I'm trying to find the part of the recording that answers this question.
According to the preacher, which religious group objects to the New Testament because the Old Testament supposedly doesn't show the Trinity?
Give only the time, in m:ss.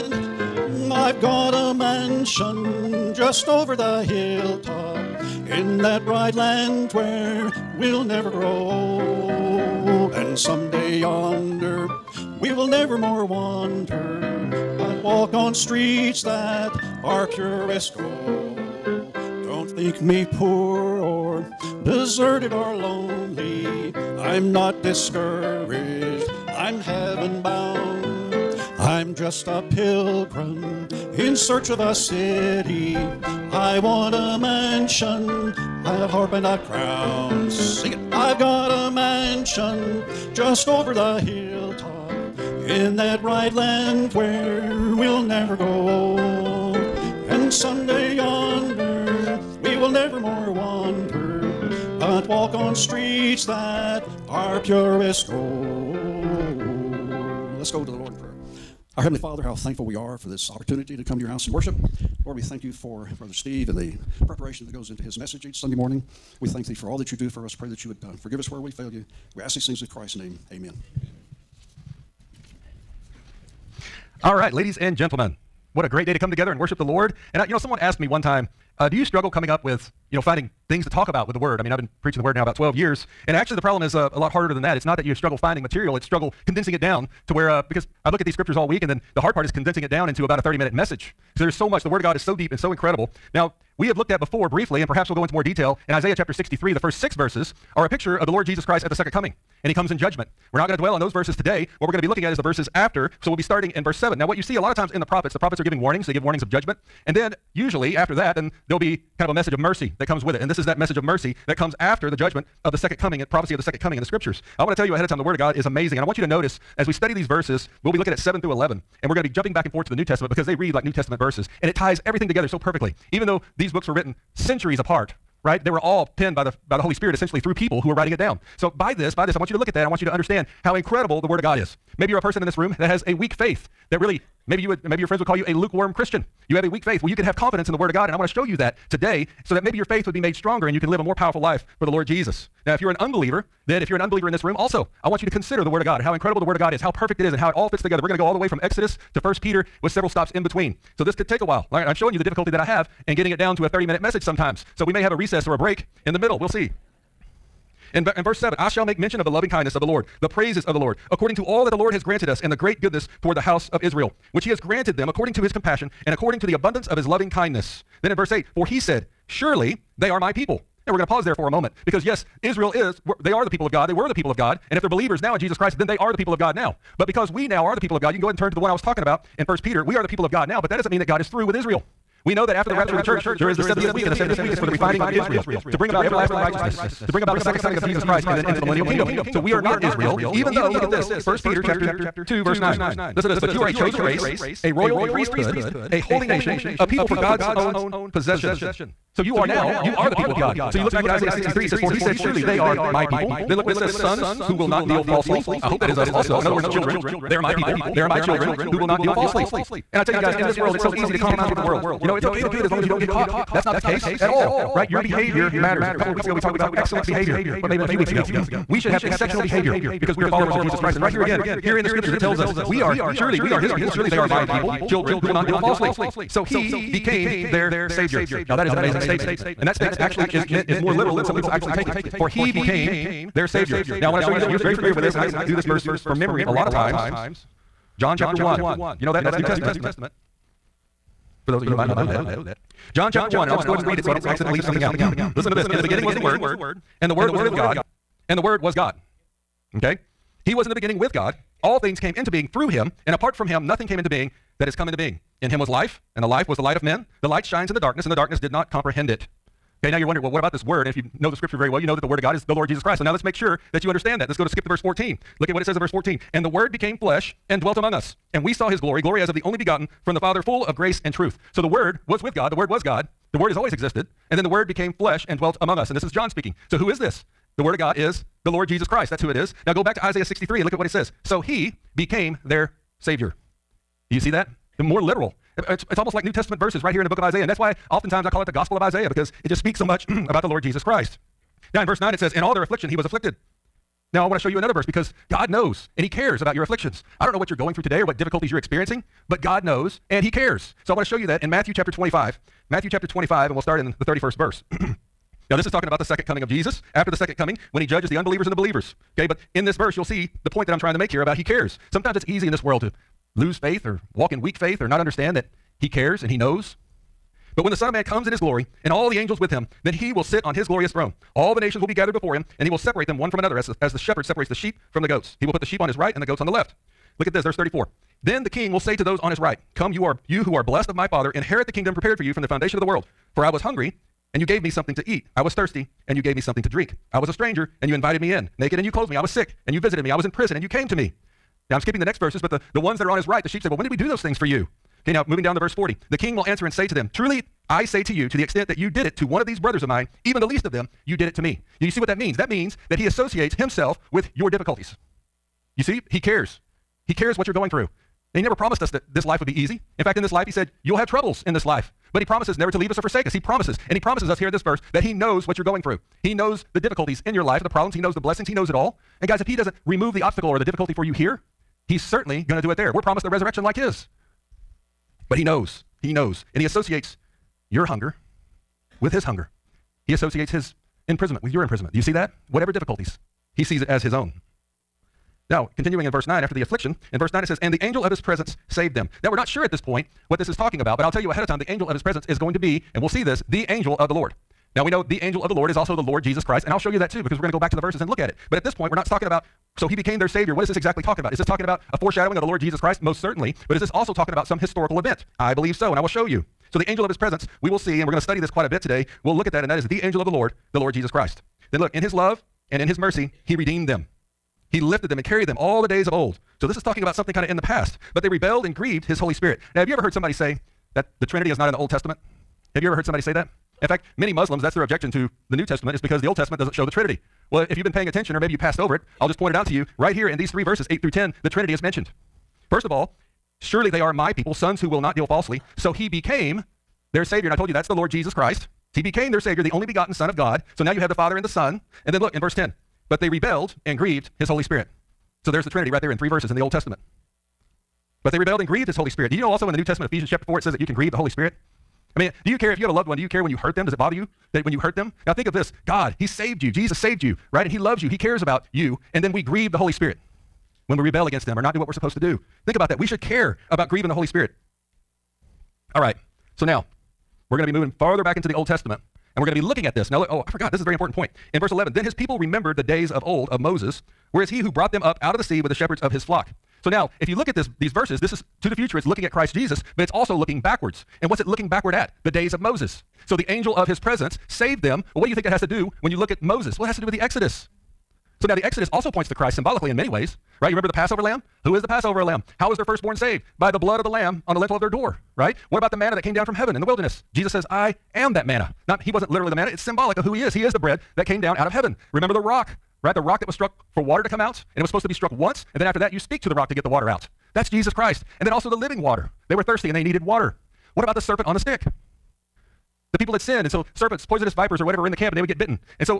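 7:04.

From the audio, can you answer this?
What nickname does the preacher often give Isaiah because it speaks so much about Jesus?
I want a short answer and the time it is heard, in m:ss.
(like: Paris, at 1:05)
Gospel of Isaiah, at 4:48.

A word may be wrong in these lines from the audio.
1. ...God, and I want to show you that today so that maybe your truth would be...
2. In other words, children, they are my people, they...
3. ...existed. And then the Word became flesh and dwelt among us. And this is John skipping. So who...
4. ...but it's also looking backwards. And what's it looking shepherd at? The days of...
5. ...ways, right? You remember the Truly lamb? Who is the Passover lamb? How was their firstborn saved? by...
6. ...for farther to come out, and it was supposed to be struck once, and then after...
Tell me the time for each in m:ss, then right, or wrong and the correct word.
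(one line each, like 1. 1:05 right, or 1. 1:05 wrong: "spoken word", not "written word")
1. 2:17 wrong: "faith", not "truth"
2. 3:26 right
3. 4:33 wrong: "speaking", not "skipping"
4. 7:59 wrong: "backward", not "shepherd"
5. 8:10 wrong: "Passover", not "Truly"
6. 8:23 wrong: "water", not "farther".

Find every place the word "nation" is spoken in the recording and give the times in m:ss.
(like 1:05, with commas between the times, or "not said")
3:16, 5:21.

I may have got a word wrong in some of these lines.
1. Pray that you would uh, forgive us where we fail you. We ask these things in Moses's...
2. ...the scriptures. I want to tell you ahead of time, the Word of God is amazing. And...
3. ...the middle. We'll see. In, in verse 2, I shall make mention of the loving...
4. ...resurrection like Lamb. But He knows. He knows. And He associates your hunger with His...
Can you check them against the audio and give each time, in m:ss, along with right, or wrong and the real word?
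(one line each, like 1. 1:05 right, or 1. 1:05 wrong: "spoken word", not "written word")
1. 1:07 wrong: "Christ", not "Moses"
2. 1:54 right
3. 2:36 wrong: "7", not "2"
4. 6:13 wrong: "His", not "Lamb".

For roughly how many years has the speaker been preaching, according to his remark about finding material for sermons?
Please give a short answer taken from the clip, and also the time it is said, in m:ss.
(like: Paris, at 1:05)
12 years, at 1:22.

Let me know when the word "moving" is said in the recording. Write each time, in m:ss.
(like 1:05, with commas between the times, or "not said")
5:45, 7:47.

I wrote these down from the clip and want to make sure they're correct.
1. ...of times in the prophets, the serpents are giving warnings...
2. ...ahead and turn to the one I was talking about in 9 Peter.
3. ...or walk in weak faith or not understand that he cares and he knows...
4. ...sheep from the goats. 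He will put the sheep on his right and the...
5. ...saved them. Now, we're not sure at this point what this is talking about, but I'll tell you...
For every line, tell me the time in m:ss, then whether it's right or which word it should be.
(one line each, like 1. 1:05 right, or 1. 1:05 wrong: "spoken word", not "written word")
1. 1:44 wrong: "prophets", not "serpents"
2. 2:58 wrong: "1", not "9"
3. 5:13 right
4. 5:24 right
5. 6:28 right.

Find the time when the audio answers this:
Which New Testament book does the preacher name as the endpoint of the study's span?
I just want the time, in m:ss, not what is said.
2:29.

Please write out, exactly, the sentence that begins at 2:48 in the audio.
Then in verse 8, for he said, Surely they are my people.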